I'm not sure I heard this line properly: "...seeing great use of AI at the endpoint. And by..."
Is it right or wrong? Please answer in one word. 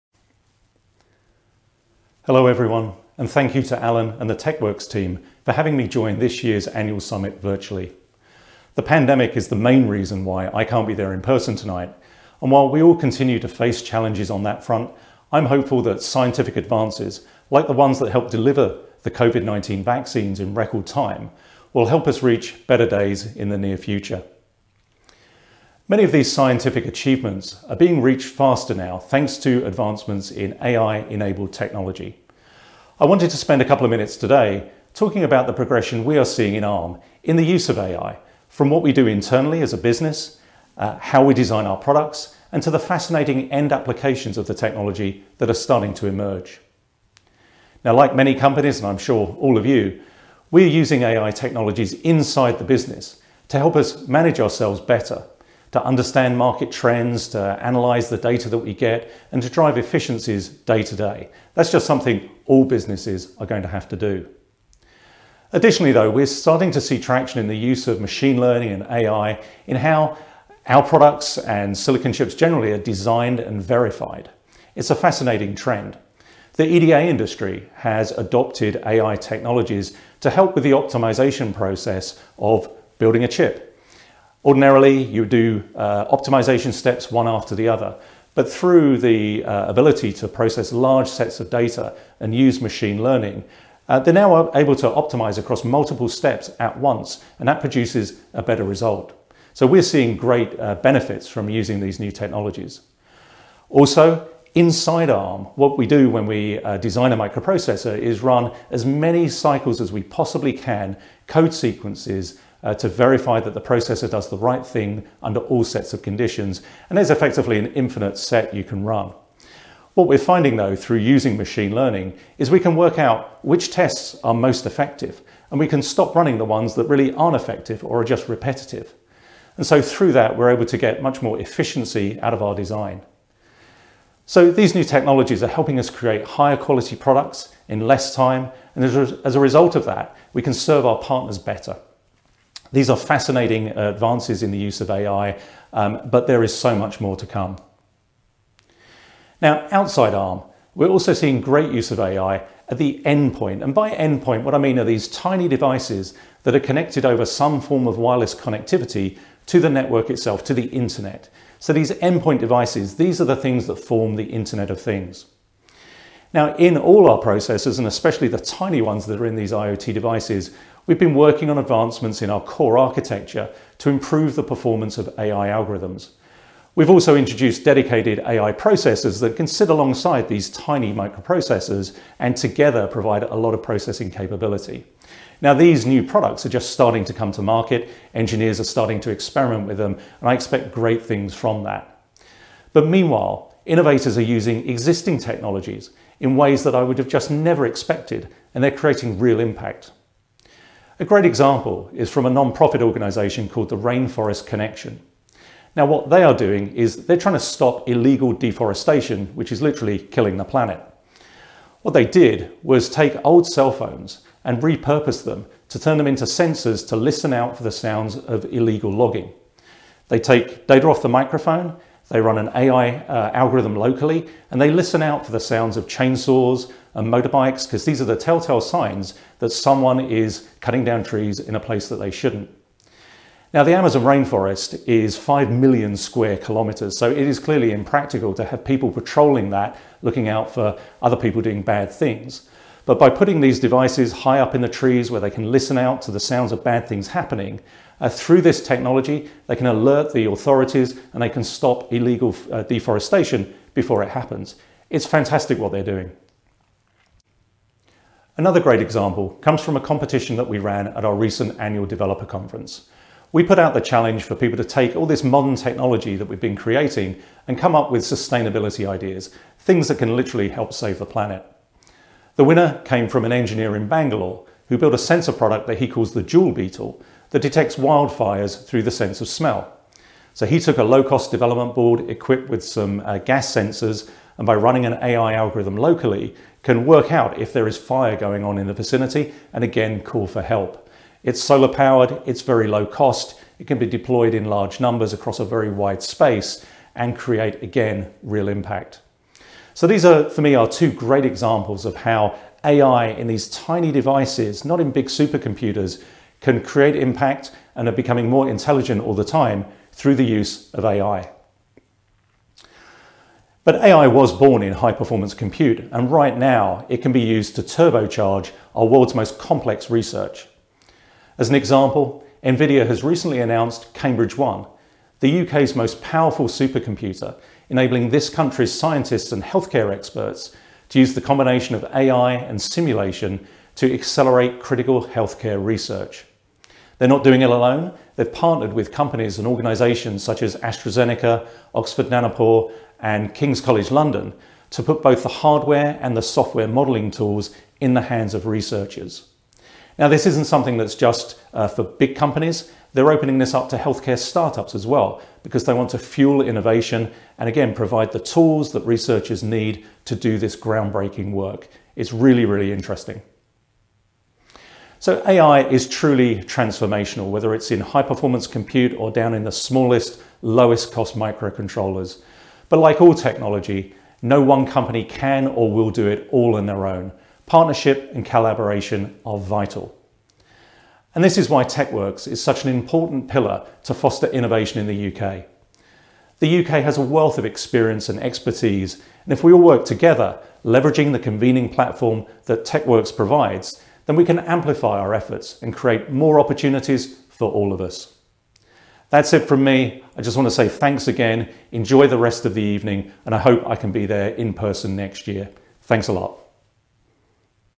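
right.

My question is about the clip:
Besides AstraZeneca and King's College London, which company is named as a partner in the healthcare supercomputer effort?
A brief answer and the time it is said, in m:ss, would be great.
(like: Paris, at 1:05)
Oxford Nanopore, at 5:41.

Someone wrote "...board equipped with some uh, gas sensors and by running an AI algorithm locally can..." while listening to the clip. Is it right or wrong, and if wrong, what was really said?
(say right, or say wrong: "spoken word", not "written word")
right.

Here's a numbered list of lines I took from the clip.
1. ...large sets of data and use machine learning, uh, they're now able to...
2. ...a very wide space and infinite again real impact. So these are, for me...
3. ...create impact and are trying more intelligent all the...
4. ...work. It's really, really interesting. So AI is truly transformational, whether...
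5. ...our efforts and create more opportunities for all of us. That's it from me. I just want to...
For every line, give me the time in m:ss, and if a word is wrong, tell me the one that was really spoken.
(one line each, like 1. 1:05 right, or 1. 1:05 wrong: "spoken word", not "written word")
1. 1:30 right
2. 4:55 wrong: "create", not "infinite"
3. 5:06 wrong: "becoming", not "trying"
4. 6:01 right
5. 6:34 right.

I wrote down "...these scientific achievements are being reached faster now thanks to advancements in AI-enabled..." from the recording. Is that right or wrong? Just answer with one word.
right.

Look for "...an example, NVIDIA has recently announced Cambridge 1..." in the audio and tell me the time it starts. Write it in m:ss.
5:21.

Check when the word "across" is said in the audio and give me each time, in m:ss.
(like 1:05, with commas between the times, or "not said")
1:35, 4:55.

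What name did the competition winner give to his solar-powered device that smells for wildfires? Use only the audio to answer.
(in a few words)
Jewel Beetle.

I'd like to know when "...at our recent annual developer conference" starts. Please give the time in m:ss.
4:20.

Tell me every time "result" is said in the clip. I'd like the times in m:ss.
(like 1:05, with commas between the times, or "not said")
1:38, 2:19.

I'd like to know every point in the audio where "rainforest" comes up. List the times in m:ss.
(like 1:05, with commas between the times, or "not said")
3:23, 3:54.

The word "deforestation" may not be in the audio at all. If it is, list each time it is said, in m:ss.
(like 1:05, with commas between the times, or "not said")
3:28, 4:12.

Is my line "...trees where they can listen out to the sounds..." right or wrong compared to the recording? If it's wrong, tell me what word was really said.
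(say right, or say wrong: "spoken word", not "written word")
right.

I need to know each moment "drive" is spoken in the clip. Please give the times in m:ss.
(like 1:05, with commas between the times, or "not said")
0:59.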